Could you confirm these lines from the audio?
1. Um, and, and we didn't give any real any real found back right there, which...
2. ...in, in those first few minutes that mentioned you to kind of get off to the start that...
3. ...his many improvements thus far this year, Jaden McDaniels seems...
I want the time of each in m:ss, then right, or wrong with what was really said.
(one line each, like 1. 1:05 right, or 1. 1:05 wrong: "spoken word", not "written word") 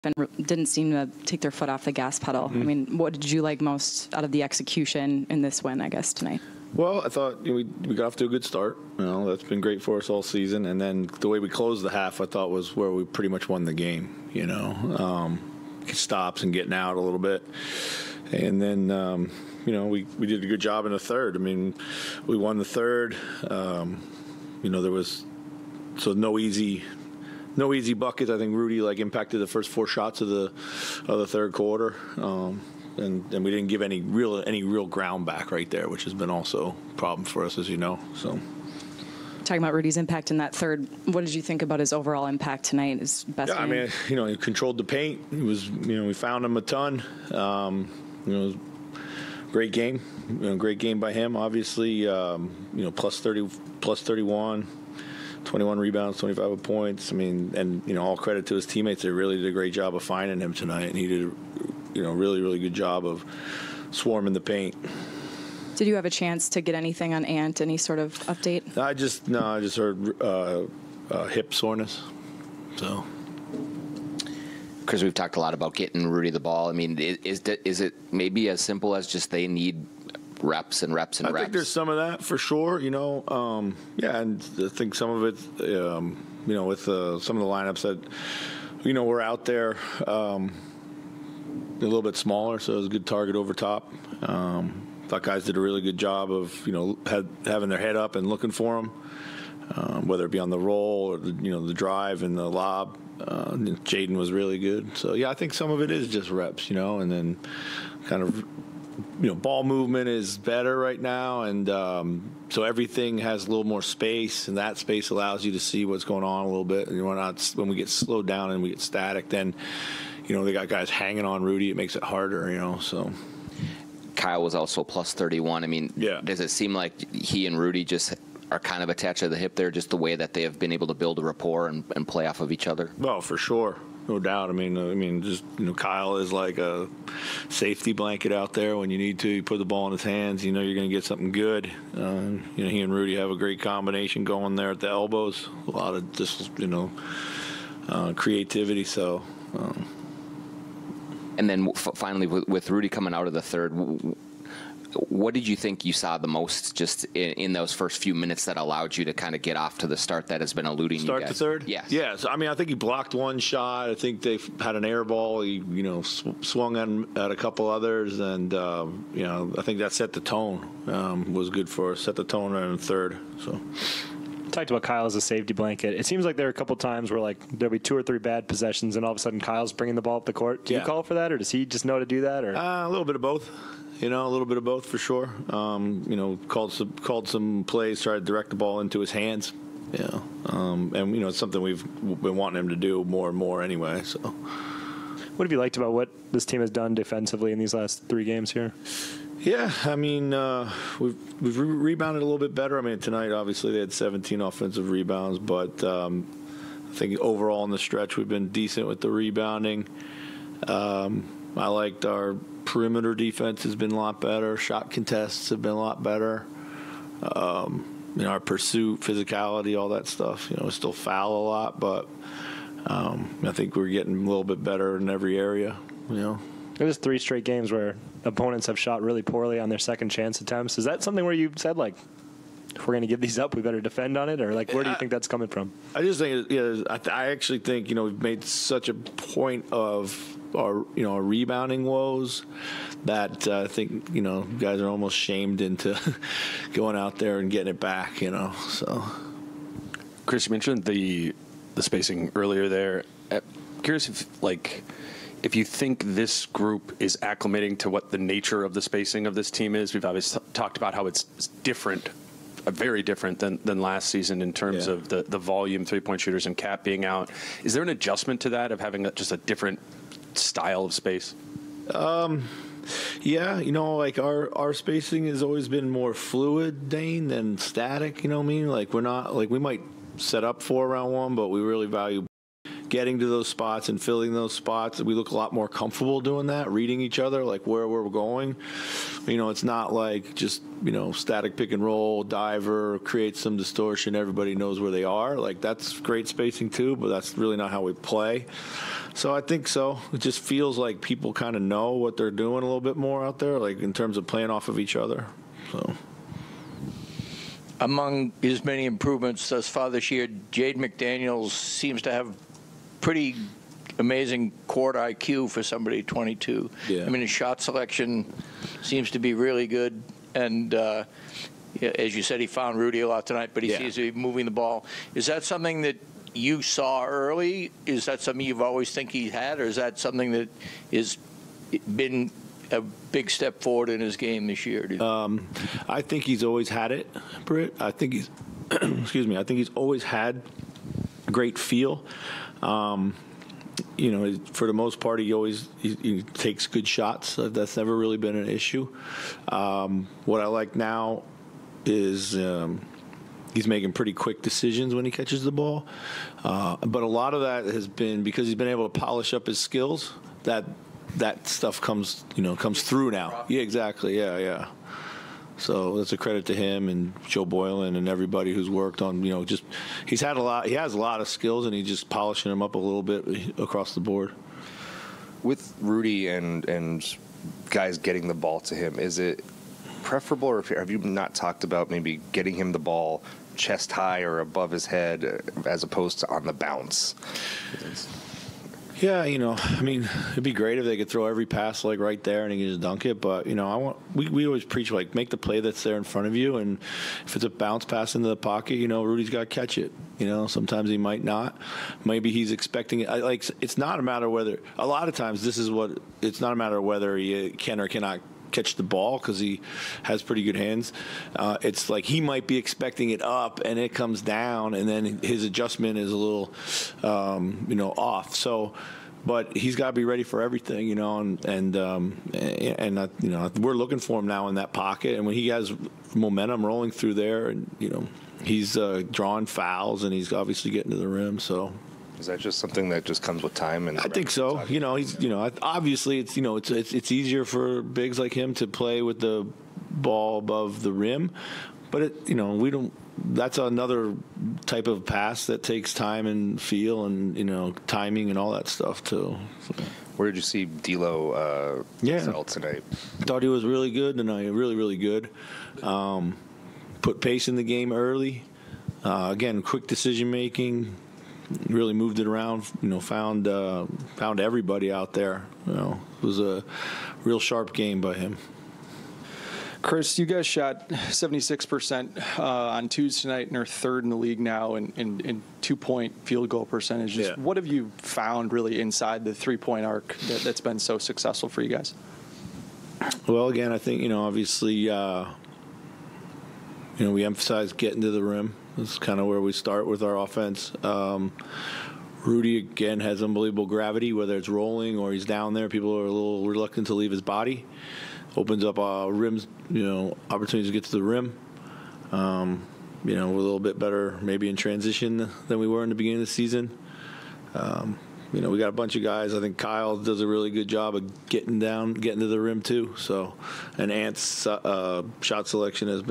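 1. 0:32 wrong: "ground", not "found"
2. 2:37 wrong: "allowed", not "mentioned"
3. 5:08 right.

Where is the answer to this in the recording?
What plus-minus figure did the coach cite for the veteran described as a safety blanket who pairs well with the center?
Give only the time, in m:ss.
2:04.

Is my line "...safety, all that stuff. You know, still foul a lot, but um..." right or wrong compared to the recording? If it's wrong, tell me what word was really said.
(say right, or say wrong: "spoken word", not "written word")
wrong: "physicality", not "safety".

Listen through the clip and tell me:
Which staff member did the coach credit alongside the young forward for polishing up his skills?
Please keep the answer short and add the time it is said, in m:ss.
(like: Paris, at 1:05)
Joe Boylan, at 6:07.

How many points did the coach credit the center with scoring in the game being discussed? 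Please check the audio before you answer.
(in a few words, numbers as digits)
25.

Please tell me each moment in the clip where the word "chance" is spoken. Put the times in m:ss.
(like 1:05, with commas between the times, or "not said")
1:06, 3:50.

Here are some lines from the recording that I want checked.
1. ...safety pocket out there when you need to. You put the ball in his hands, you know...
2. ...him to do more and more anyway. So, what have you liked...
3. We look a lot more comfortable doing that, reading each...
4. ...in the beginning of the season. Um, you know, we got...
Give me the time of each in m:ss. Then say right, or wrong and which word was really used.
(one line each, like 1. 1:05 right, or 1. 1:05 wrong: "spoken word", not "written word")
1. 2:17 wrong: "blanket", not "pocket"
2. 3:12 right
3. 4:45 right
4. 8:25 right.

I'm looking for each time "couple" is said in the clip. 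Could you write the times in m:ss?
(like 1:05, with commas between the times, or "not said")
2:47, 2:56.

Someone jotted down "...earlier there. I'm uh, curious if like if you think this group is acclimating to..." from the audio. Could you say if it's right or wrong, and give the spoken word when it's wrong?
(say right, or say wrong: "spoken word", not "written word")
right.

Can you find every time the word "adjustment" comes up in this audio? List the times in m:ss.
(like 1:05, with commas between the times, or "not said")
4:27, 6:55.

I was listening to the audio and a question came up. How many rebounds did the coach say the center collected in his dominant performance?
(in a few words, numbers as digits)
21.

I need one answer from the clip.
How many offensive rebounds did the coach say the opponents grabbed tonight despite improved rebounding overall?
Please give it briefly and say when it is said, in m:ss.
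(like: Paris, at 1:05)
17, at 3:23.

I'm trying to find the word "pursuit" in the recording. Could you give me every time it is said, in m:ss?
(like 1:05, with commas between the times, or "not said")
3:38.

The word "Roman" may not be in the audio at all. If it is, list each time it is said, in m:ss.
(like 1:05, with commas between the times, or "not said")
not said.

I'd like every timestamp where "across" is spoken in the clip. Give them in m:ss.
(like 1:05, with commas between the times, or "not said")
6:13.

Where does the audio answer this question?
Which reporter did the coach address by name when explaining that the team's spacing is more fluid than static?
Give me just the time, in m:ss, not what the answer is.
4:36.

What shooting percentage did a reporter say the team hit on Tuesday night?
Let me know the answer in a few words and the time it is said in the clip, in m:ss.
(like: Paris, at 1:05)
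76%, at 7:50.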